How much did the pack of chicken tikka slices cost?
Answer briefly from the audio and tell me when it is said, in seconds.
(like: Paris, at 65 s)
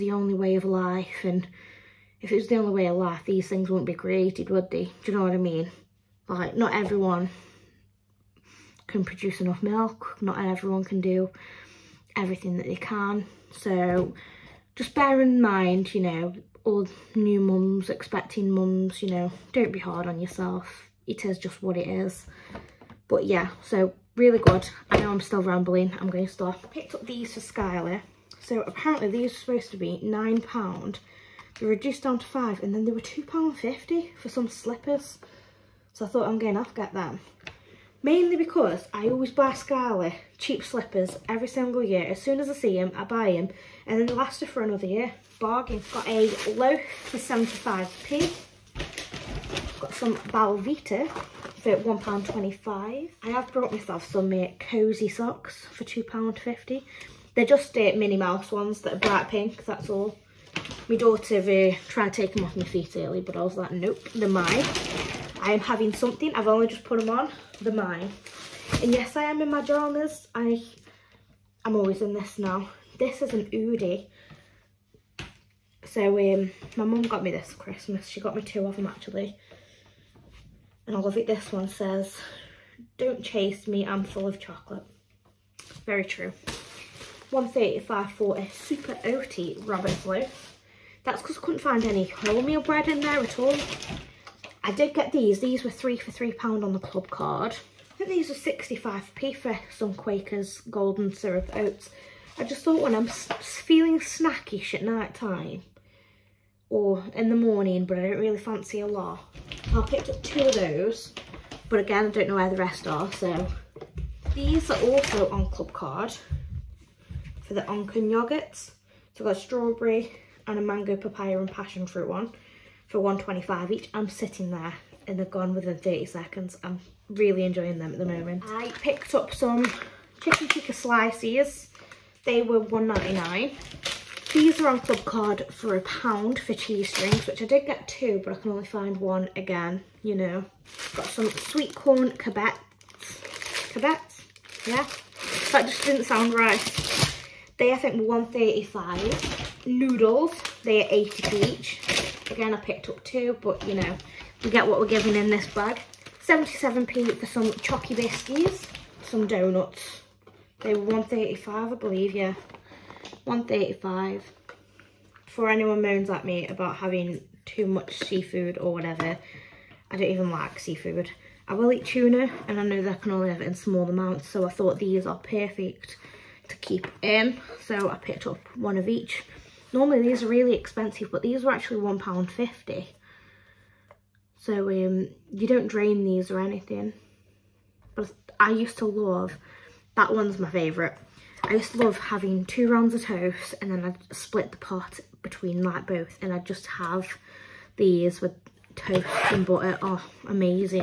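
£1.99, at 132 s.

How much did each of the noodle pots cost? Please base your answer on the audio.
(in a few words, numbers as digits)
80p.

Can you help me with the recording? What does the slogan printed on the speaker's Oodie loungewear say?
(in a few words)
Don't chase me, I'm full of chocolate.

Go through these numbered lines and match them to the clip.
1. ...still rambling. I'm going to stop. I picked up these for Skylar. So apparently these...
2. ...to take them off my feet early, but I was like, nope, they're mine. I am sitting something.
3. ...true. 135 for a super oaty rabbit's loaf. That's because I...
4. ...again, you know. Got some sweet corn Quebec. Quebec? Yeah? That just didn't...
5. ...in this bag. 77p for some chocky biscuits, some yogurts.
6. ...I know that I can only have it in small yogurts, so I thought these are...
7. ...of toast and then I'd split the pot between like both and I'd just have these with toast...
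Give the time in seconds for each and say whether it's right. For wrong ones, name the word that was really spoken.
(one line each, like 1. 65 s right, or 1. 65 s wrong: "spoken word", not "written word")
1. 25 s right
2. 62 s wrong: "having", not "sitting"
3. 86 s right
4. 139 s right
5. 155 s wrong: "donuts", not "yogurts"
6. 172 s wrong: "amounts", not "yogurts"
7. 192 s right.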